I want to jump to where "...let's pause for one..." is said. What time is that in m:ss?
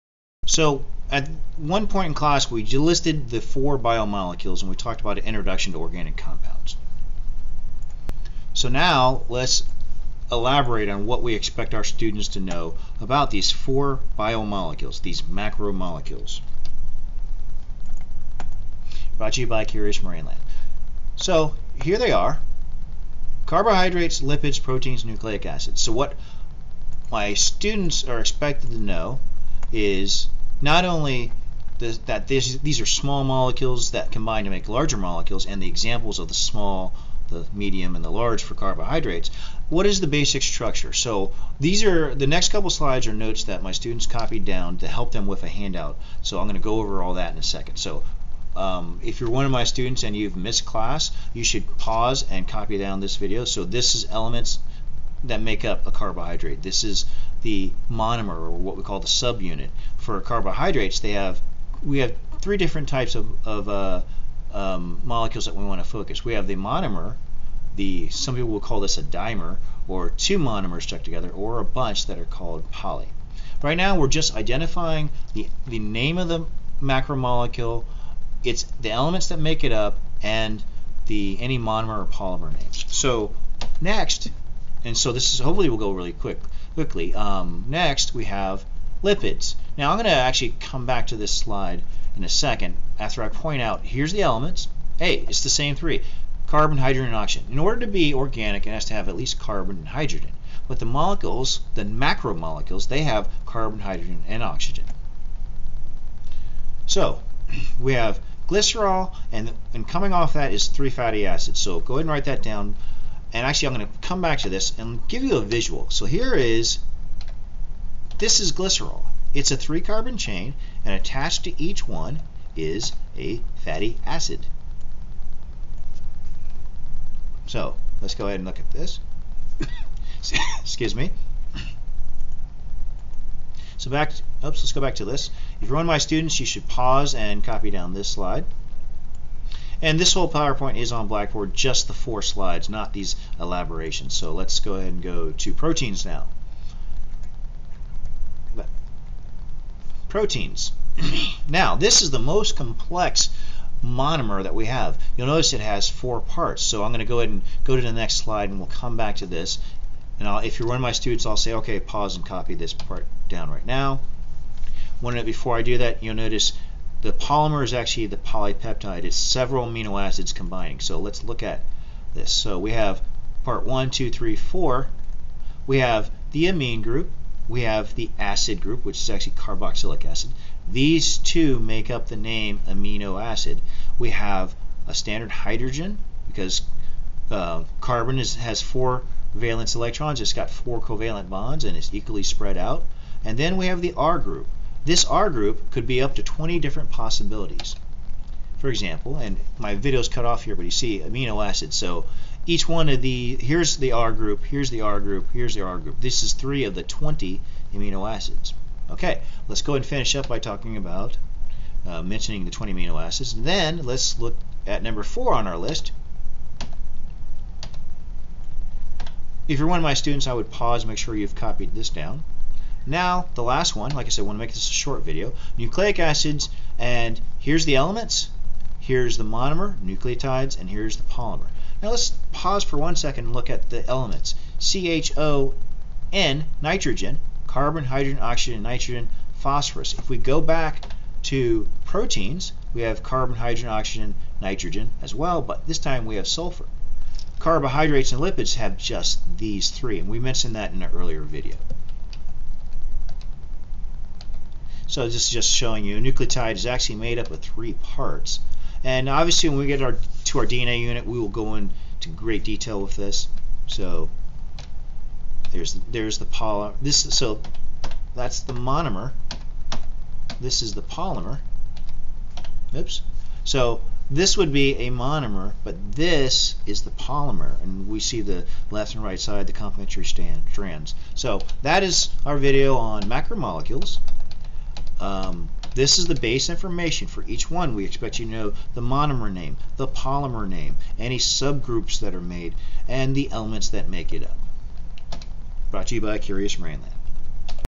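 3:51.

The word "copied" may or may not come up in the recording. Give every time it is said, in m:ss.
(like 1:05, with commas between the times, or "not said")
0:44, 3:41.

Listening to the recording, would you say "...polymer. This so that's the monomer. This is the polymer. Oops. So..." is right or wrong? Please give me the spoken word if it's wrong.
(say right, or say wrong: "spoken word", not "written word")
right.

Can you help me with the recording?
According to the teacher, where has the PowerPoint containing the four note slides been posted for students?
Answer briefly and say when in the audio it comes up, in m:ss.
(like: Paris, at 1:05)
Blackboard, at 2:21.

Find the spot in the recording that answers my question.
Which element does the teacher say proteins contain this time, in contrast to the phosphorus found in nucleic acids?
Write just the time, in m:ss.
4:06.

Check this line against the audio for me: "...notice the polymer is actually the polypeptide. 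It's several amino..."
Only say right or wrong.
right.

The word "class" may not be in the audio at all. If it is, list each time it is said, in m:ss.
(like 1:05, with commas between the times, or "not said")
0:02, 0:50.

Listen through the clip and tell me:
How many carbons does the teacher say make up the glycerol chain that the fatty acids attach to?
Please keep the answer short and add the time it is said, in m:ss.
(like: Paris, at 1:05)
3, at 1:59.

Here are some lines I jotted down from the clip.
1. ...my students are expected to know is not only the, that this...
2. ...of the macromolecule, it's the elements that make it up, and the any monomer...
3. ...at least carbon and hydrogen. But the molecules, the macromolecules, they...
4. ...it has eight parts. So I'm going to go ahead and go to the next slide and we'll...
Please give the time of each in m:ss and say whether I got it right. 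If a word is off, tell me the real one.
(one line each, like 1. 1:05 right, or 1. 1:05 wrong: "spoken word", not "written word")
1. 0:27 right
2. 1:16 right
3. 1:39 right
4. 2:35 wrong: "four", not "eight".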